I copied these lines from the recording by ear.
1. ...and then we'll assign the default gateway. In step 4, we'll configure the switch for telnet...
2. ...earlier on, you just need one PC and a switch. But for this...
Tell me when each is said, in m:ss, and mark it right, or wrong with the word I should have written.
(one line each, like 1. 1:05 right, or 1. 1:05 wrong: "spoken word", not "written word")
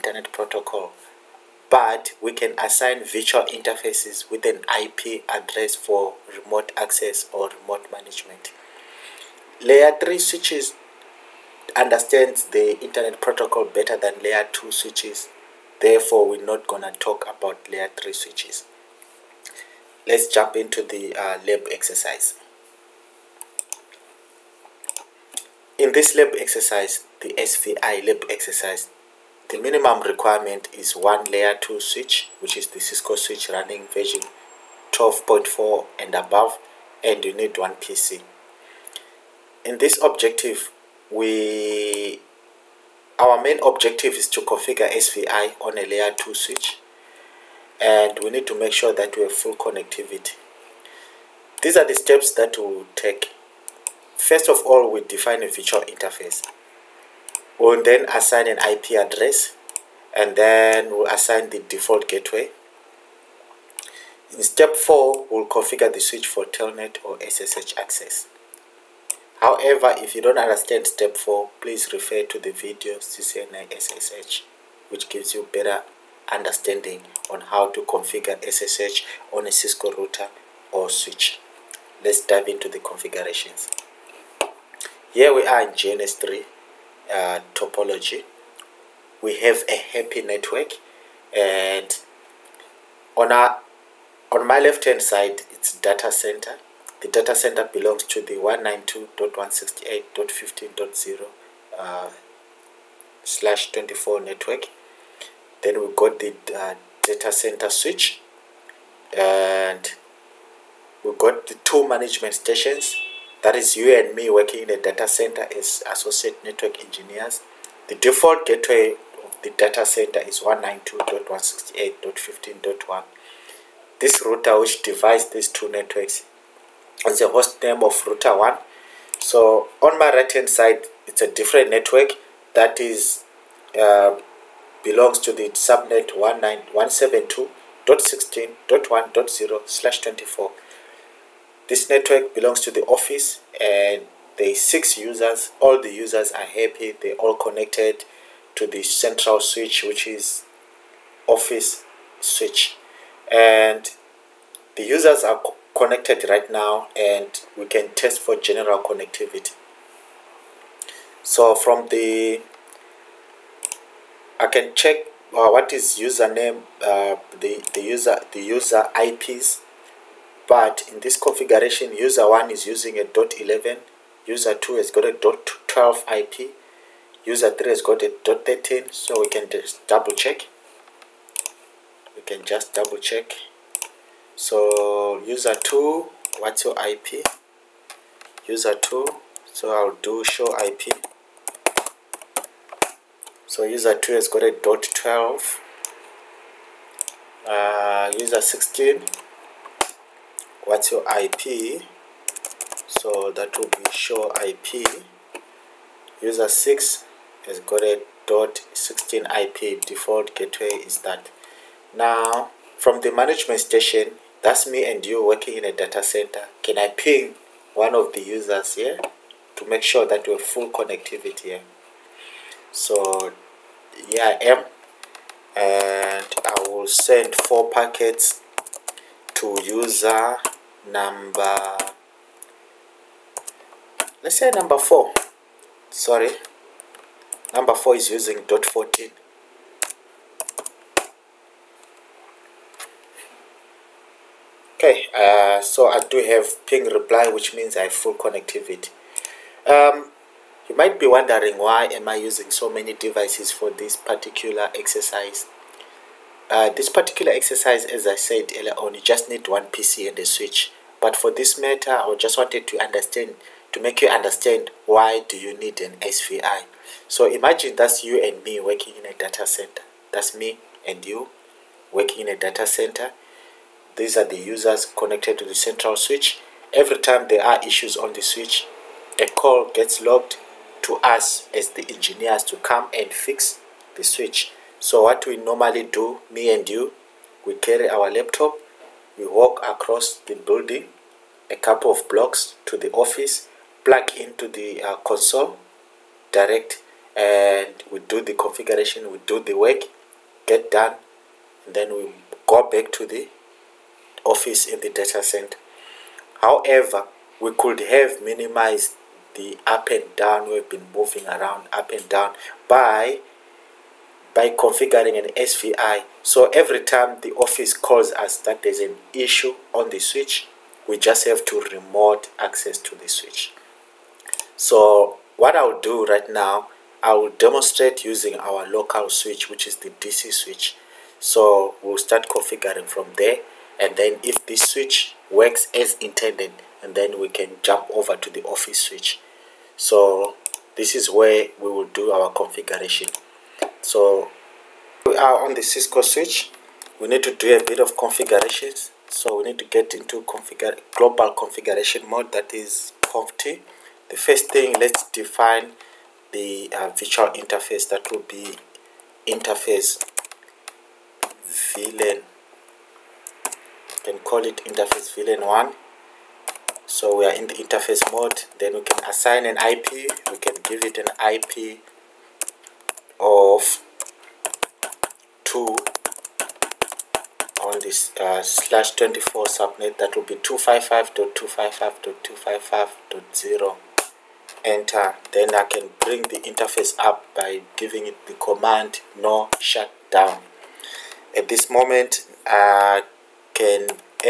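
1. 1:00 right
2. 4:18 right.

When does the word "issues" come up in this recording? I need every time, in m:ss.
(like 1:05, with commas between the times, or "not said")
4:37, 5:19.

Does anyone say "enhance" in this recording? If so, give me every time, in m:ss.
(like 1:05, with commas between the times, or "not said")
not said.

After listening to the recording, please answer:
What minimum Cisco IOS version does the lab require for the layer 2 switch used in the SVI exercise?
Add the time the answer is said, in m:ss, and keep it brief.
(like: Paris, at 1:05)
12.4, at 0:34.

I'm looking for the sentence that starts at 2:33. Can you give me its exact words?
And the users are connected right now and we can test for general connectivity.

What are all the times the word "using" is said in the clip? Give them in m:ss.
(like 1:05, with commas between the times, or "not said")
2:52, 3:58, 4:12, 5:28.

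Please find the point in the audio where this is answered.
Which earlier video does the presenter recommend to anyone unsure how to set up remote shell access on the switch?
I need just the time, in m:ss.
1:12.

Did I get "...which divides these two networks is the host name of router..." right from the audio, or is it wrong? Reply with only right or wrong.
right.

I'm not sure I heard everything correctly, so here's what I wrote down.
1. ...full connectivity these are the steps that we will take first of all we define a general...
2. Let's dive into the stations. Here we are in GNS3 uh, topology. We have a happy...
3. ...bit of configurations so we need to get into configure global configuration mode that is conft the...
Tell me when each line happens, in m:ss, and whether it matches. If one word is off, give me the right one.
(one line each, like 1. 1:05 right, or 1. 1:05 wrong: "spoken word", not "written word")
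1. 0:49 wrong: "virtual", not "general"
2. 1:22 wrong: "configurations", not "stations"
3. 5:47 right.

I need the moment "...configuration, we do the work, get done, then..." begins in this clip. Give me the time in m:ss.
4:58.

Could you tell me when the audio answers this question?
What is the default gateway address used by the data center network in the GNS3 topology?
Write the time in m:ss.
2:00.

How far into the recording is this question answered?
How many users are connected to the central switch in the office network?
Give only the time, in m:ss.
2:24.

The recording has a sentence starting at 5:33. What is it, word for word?
And then if this switch works as intended, and then we can jump over to the office switch.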